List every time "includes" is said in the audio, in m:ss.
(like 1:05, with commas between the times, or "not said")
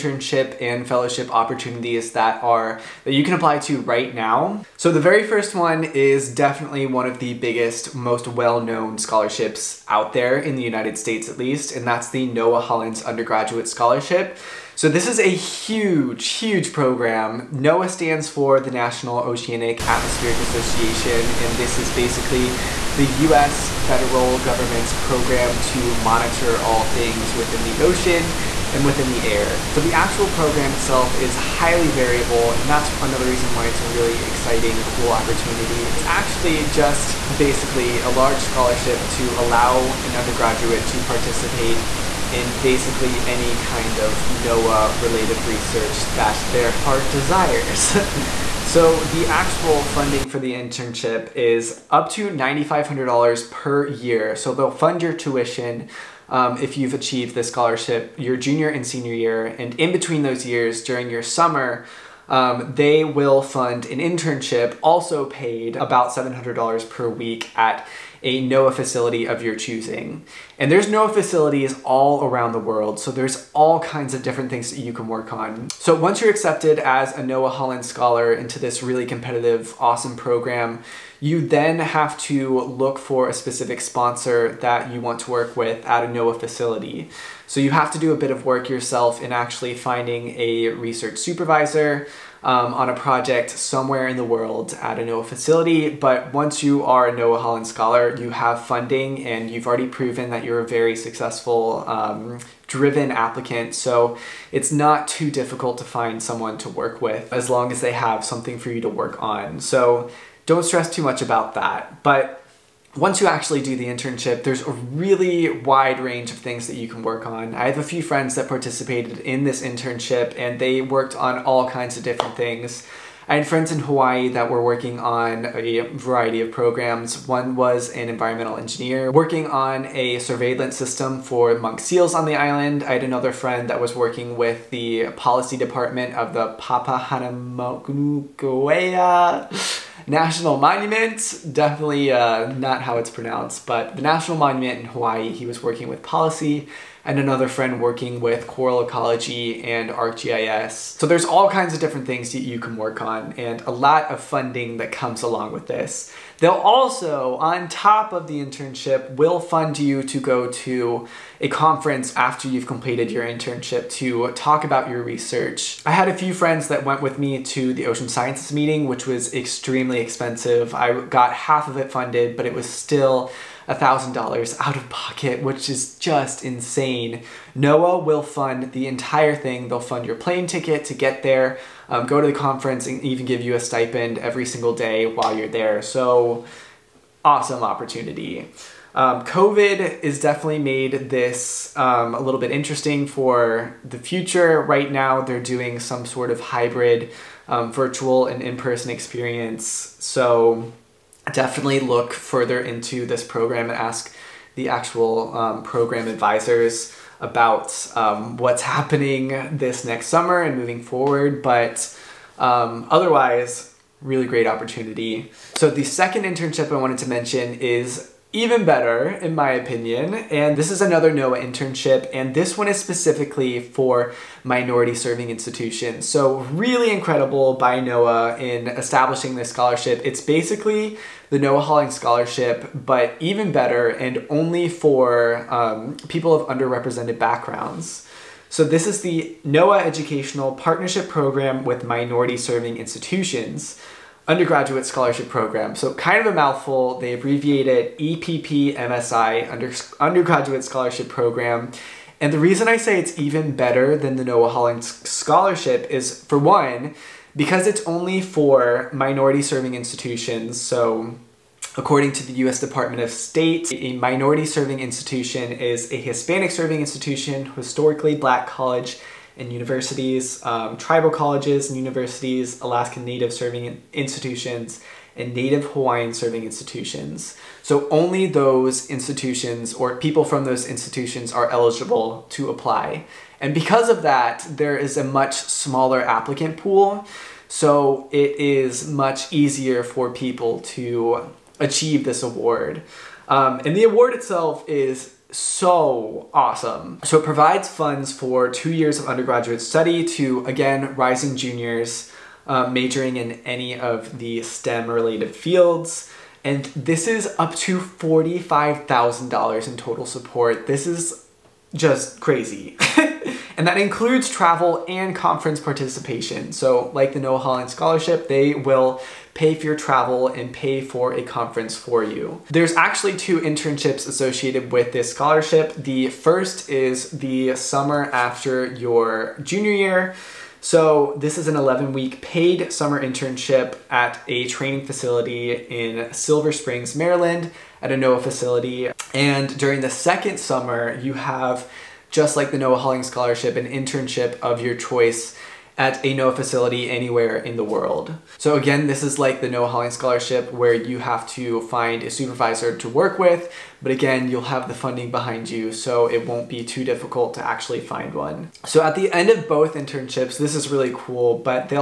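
5:13.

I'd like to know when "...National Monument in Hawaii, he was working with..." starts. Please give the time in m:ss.
2:24.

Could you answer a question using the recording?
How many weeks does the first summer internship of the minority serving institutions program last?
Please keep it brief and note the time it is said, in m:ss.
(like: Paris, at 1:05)
11, at 5:31.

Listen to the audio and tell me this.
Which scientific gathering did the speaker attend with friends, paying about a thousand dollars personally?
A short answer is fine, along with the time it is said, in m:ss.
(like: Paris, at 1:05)
Ocean Sciences meeting, at 2:47.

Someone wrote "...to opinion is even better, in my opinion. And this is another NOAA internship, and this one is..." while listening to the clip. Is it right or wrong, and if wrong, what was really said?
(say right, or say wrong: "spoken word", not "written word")
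wrong: "mention", not "opinion".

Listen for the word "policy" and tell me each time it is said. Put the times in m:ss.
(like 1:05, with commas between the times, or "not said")
2:15, 2:26.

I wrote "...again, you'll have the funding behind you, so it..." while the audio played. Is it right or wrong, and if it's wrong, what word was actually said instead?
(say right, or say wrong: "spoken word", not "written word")
right.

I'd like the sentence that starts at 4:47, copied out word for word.
So it is much easier for people to achieve this award.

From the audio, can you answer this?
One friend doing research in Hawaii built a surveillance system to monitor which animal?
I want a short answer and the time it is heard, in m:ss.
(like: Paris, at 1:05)
monk seals, at 2:11.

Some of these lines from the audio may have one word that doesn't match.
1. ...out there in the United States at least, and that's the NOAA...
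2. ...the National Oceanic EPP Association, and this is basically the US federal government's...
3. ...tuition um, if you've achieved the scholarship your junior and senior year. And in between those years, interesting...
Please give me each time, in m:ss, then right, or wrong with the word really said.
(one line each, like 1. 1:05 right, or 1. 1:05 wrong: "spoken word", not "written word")
1. 0:09 right
2. 0:18 wrong: "Atmospheric", not "EPP"
3. 0:55 wrong: "during", not "interesting".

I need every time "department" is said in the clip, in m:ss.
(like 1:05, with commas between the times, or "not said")
2:15, 4:22.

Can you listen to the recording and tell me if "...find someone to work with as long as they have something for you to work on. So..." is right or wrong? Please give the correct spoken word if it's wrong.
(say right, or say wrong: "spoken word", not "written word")
right.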